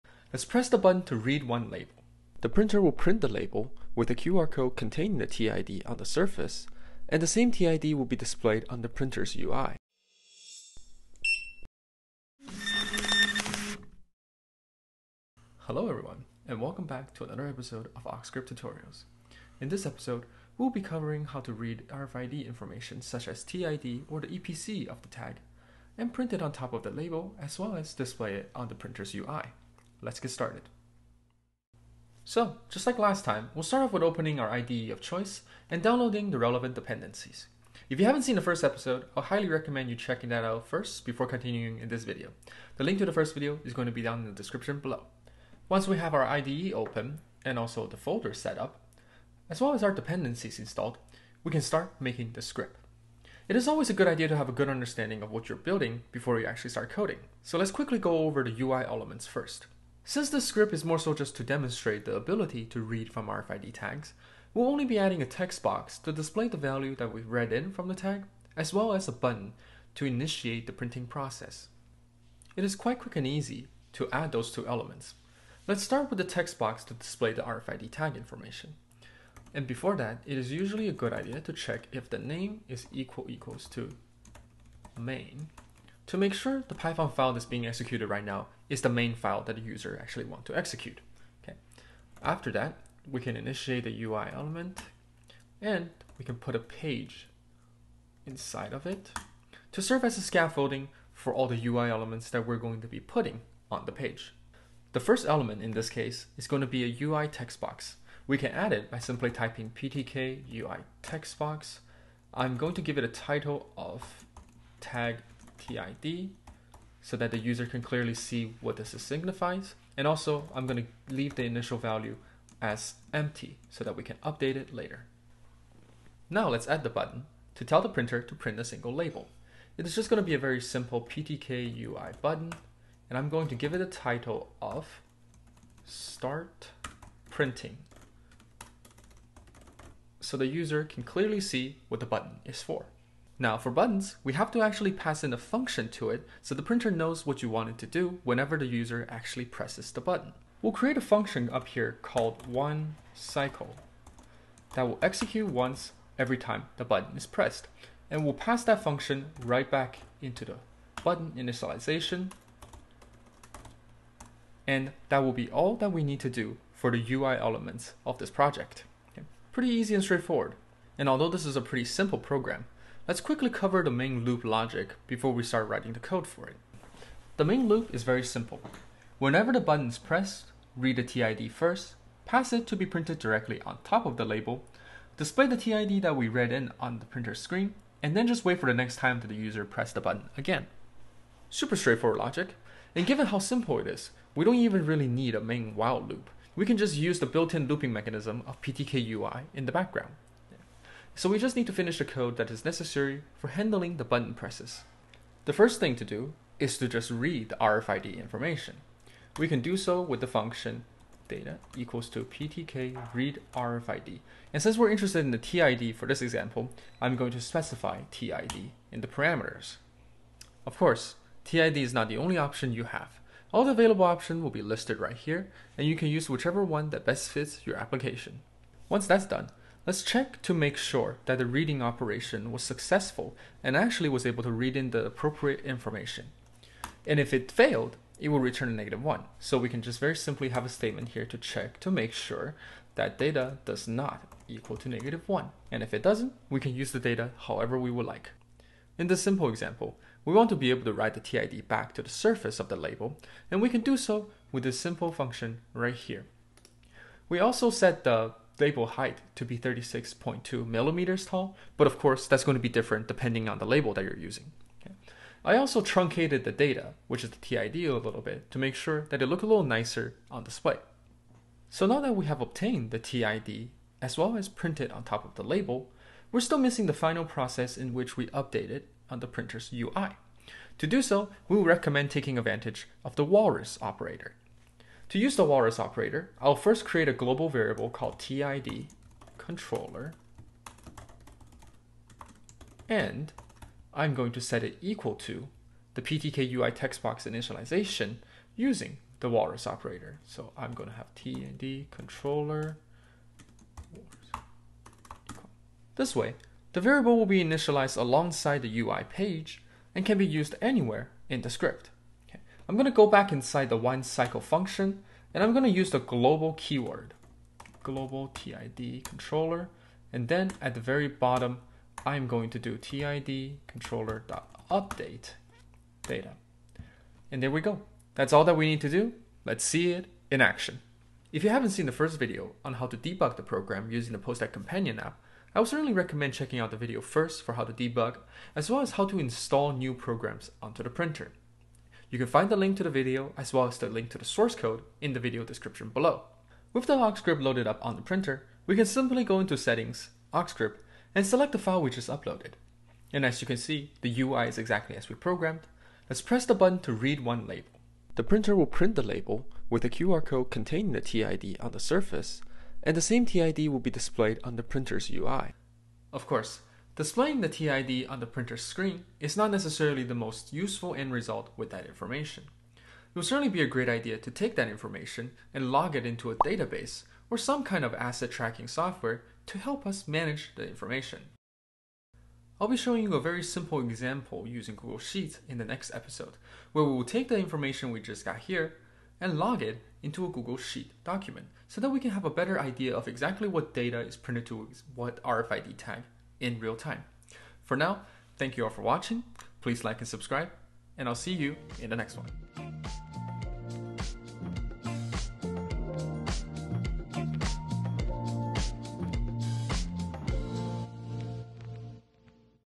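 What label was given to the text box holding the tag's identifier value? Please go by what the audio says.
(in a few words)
tag TID.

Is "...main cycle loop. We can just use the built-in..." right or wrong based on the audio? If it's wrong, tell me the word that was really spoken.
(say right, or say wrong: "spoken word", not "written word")
wrong: "while", not "cycle".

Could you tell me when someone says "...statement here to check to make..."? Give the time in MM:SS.
04:00.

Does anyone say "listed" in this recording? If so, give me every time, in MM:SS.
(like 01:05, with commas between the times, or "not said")
03:44.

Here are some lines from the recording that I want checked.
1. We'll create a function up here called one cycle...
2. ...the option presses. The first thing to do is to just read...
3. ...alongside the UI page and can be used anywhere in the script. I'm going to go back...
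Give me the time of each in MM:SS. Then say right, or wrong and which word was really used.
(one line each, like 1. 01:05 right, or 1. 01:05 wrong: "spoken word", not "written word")
1. 02:30 right
2. 03:23 wrong: "button", not "option"
3. 05:07 right.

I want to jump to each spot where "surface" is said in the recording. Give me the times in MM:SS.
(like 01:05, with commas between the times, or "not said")
00:06, 04:12, 06:01.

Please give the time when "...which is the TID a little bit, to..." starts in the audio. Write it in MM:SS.
04:27.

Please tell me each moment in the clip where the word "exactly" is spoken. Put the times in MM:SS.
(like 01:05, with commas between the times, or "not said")
05:54, 06:33.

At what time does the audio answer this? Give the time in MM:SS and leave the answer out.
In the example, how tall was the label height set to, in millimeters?
04:19.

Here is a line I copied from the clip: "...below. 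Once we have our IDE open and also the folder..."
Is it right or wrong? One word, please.
right.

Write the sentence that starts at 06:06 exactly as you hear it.
Of course, Displaying the TID on the printer's screen is not necessarily the most useful end result with that information.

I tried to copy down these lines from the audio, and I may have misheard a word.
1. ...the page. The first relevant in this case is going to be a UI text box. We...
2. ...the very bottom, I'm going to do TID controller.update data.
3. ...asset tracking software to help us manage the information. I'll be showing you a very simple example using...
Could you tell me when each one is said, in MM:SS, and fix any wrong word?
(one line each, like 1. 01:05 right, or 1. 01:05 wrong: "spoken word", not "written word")
1. 01:43 wrong: "element", not "relevant"
2. 05:20 right
3. 06:17 right.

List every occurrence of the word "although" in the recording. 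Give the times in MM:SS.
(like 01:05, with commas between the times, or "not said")
02:51.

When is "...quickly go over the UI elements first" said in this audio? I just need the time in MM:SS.
00:57.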